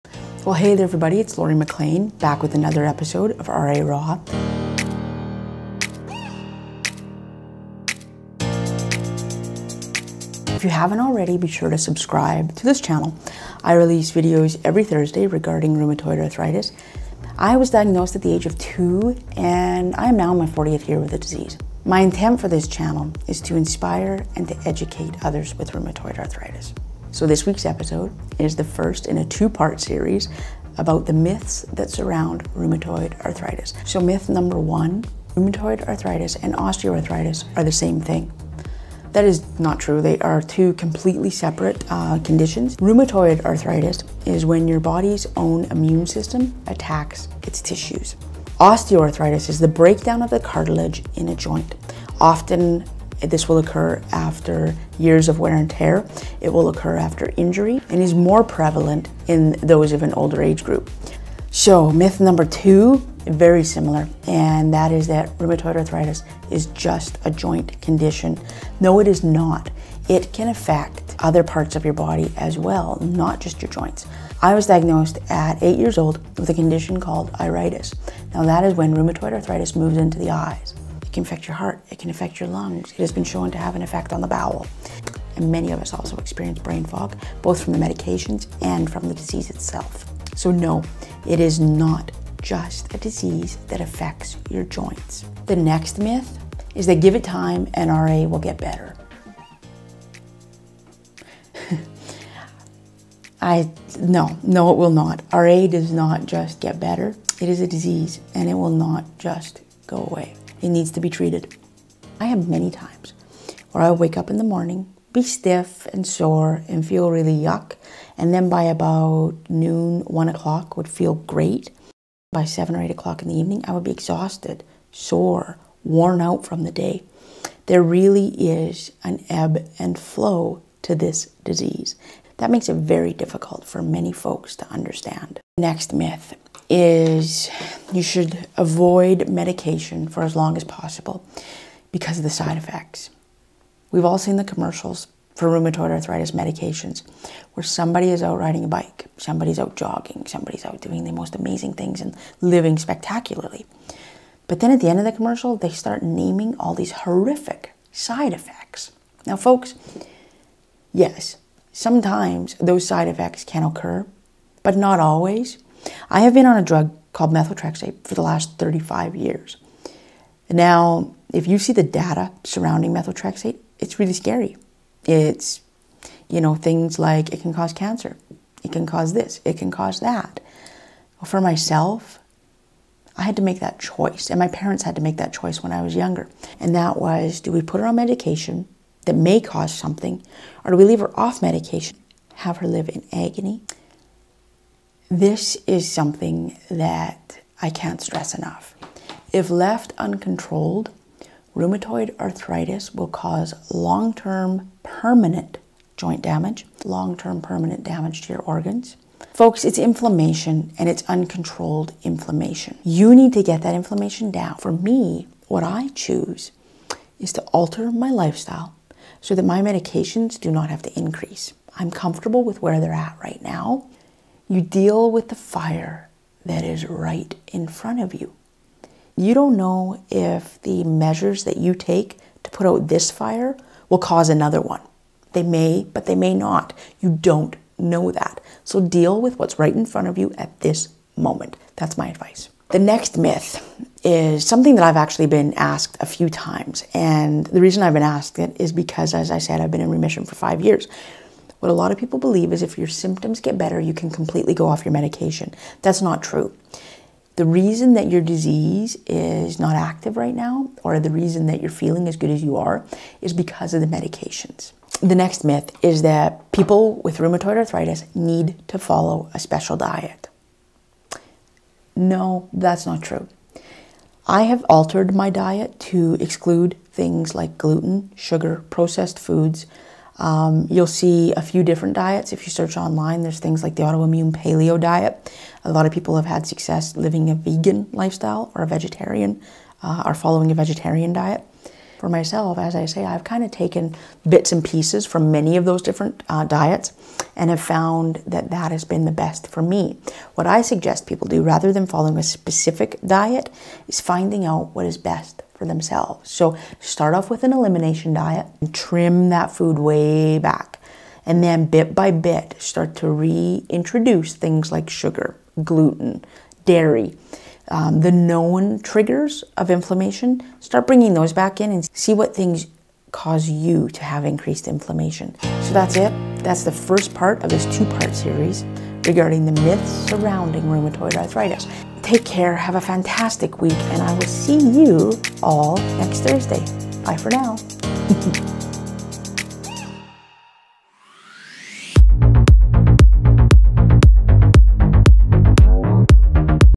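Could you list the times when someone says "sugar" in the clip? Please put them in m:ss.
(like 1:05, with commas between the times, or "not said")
4:38, 5:14.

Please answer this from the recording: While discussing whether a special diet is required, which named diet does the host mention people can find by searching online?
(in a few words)
autoimmune paleo diet.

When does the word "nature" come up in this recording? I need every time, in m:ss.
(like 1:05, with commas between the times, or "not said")
not said.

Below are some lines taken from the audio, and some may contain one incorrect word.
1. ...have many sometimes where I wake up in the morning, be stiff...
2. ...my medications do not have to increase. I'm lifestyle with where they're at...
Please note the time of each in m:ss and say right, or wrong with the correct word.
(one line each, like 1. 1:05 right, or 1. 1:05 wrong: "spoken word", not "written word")
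1. 1:52 wrong: "times", not "sometimes"
2. 3:39 wrong: "comfortable", not "lifestyle".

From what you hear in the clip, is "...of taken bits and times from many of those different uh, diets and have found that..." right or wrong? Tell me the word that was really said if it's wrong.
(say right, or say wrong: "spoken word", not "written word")
wrong: "pieces", not "times".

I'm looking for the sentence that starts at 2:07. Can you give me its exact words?
There really is an ebb and flow to this disease.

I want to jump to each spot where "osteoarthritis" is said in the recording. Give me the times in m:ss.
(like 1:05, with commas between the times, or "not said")
0:36, 0:48.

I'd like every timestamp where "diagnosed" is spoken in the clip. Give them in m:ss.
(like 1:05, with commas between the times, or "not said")
0:17, 1:14.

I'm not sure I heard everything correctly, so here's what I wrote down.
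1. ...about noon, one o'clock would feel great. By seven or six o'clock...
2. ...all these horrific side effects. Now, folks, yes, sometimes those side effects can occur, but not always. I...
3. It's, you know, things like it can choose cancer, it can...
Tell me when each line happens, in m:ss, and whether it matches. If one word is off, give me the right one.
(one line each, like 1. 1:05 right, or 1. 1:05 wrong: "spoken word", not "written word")
1. 1:58 wrong: "eight", not "six"
2. 2:36 right
3. 2:55 wrong: "cause", not "choose".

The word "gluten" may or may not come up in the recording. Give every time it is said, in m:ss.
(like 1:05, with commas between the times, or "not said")
4:37, 5:15.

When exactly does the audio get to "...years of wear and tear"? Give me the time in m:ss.
0:54.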